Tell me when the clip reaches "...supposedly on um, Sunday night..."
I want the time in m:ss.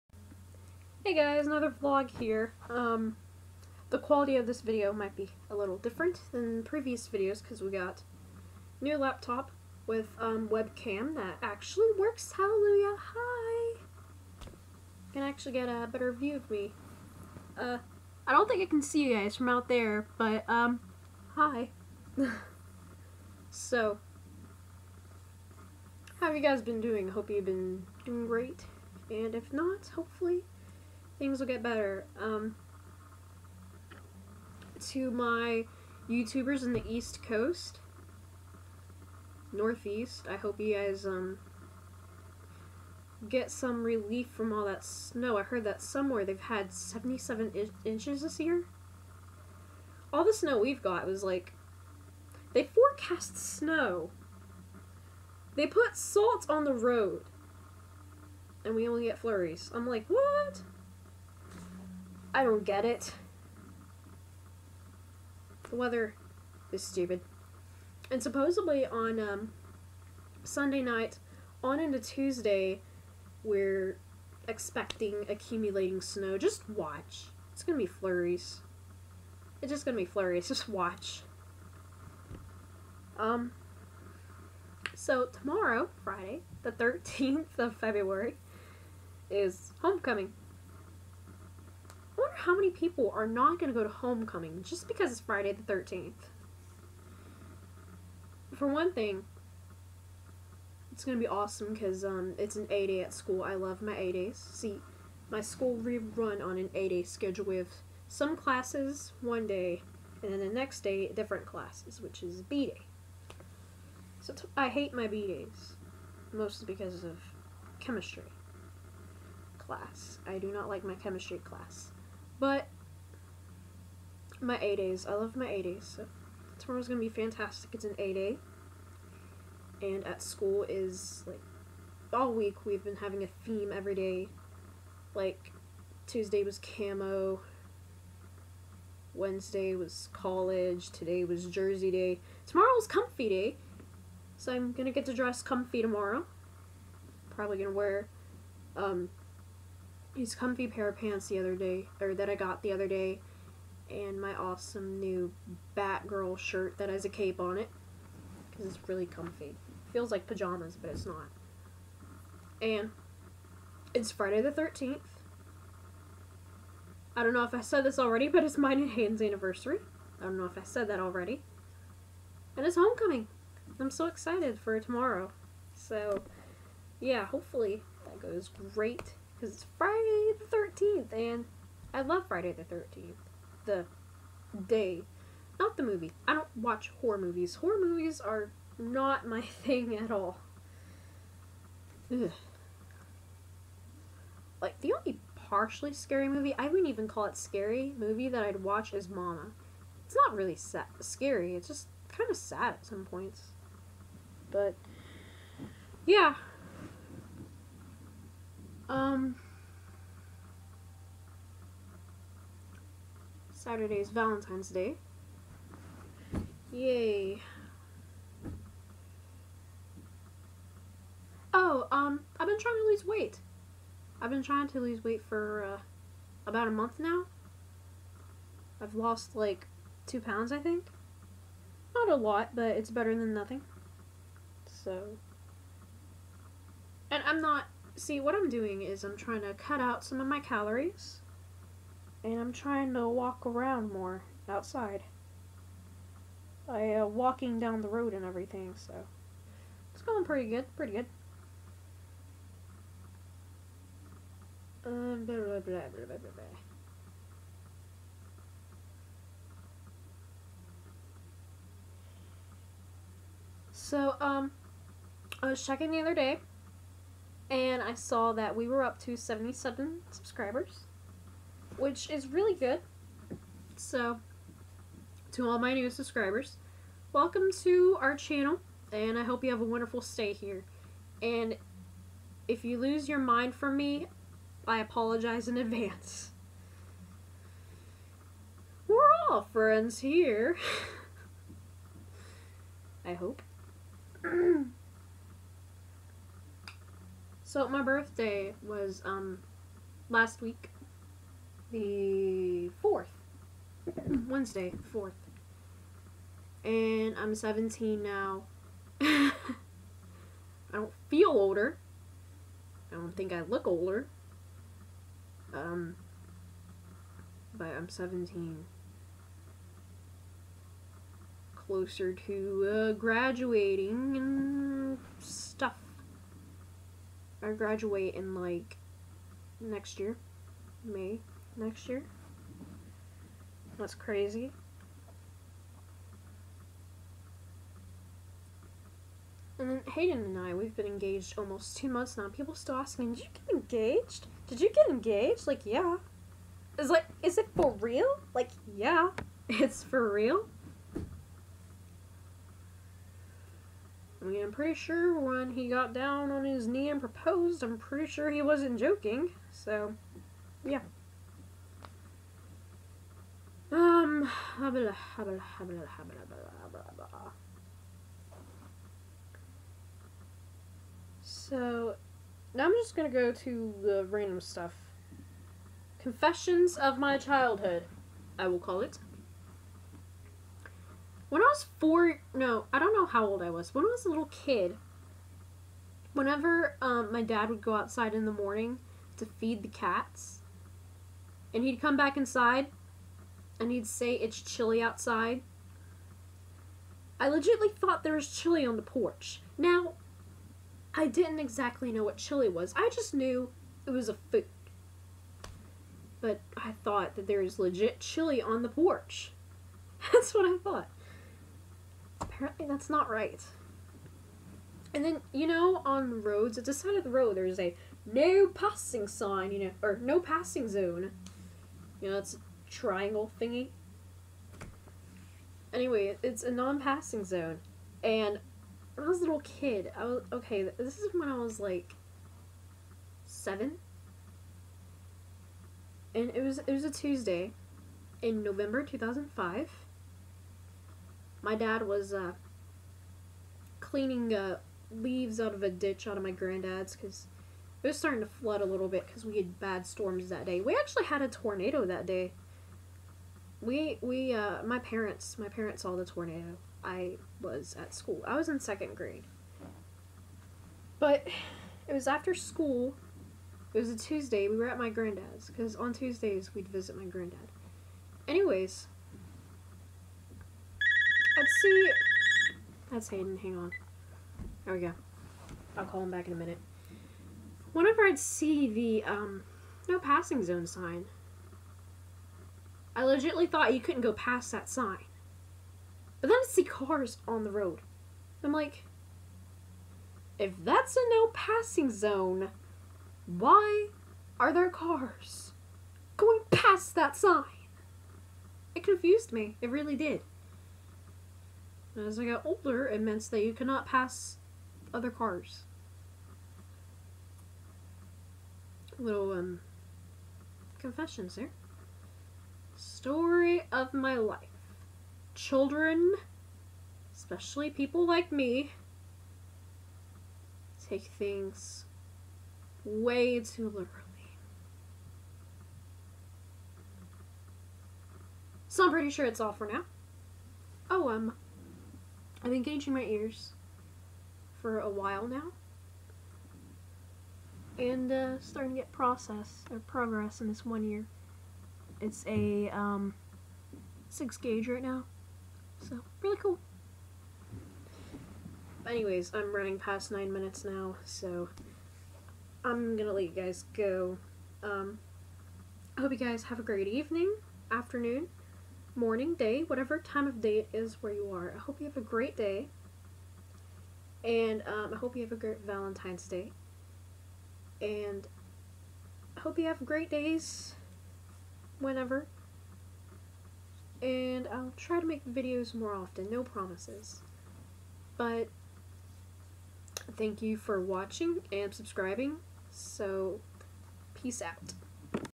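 1:08.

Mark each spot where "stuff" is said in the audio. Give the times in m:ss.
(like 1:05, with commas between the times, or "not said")
5:25, 6:14.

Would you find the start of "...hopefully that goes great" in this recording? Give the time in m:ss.
2:57.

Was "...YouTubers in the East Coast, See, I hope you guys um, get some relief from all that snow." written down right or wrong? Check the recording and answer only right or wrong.
wrong.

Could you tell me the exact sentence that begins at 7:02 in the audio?
You know, it's a triangle thingy.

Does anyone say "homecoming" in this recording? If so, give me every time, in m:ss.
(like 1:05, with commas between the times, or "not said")
1:29, 1:33, 2:52.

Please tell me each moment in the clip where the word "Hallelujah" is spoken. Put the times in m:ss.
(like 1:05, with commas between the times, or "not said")
0:12.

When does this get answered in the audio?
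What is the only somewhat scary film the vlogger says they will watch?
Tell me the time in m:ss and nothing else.
3:19.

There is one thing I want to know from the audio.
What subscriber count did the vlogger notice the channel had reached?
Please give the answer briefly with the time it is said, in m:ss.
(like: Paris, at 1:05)
77, at 4:29.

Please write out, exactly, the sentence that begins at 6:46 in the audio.
But I thought that there was legit chili on the porch.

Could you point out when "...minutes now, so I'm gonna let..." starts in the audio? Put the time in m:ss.
9:10.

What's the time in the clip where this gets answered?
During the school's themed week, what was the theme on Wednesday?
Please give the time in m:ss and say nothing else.
2:20.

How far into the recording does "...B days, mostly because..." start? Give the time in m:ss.
1:55.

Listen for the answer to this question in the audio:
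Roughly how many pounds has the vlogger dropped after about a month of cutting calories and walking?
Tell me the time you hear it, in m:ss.
3:50.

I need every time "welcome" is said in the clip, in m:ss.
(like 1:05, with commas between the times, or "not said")
4:37.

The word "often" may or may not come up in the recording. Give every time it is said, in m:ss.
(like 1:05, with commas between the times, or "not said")
9:35.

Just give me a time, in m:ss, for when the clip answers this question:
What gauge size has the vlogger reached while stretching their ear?
9:04.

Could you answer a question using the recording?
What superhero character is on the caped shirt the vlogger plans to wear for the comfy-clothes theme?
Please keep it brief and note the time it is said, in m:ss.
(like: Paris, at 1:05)
Batgirl, at 2:35.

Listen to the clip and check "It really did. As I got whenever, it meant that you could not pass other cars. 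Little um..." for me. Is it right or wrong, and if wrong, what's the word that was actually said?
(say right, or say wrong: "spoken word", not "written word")
wrong: "older", not "whenever".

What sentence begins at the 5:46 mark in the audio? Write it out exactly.
Is like, is it for real?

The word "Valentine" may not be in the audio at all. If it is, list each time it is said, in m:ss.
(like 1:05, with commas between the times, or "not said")
3:34, 9:25.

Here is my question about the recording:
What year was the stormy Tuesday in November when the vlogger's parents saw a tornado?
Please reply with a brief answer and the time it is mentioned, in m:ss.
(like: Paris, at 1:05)
2005, at 7:18.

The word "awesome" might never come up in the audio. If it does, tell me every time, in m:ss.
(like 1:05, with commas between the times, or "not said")
1:41, 2:34.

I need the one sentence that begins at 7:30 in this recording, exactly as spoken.
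We actually had a tornado that day.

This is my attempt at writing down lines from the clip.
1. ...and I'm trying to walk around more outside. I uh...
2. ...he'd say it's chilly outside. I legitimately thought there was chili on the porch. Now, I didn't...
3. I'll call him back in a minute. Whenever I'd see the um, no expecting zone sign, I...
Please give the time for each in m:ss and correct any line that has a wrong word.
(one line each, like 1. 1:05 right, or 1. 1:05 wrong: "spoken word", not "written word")
1. 4:02 right
2. 6:33 right
3. 7:55 wrong: "passing", not "expecting".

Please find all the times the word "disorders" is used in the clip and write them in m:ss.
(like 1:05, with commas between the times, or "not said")
not said.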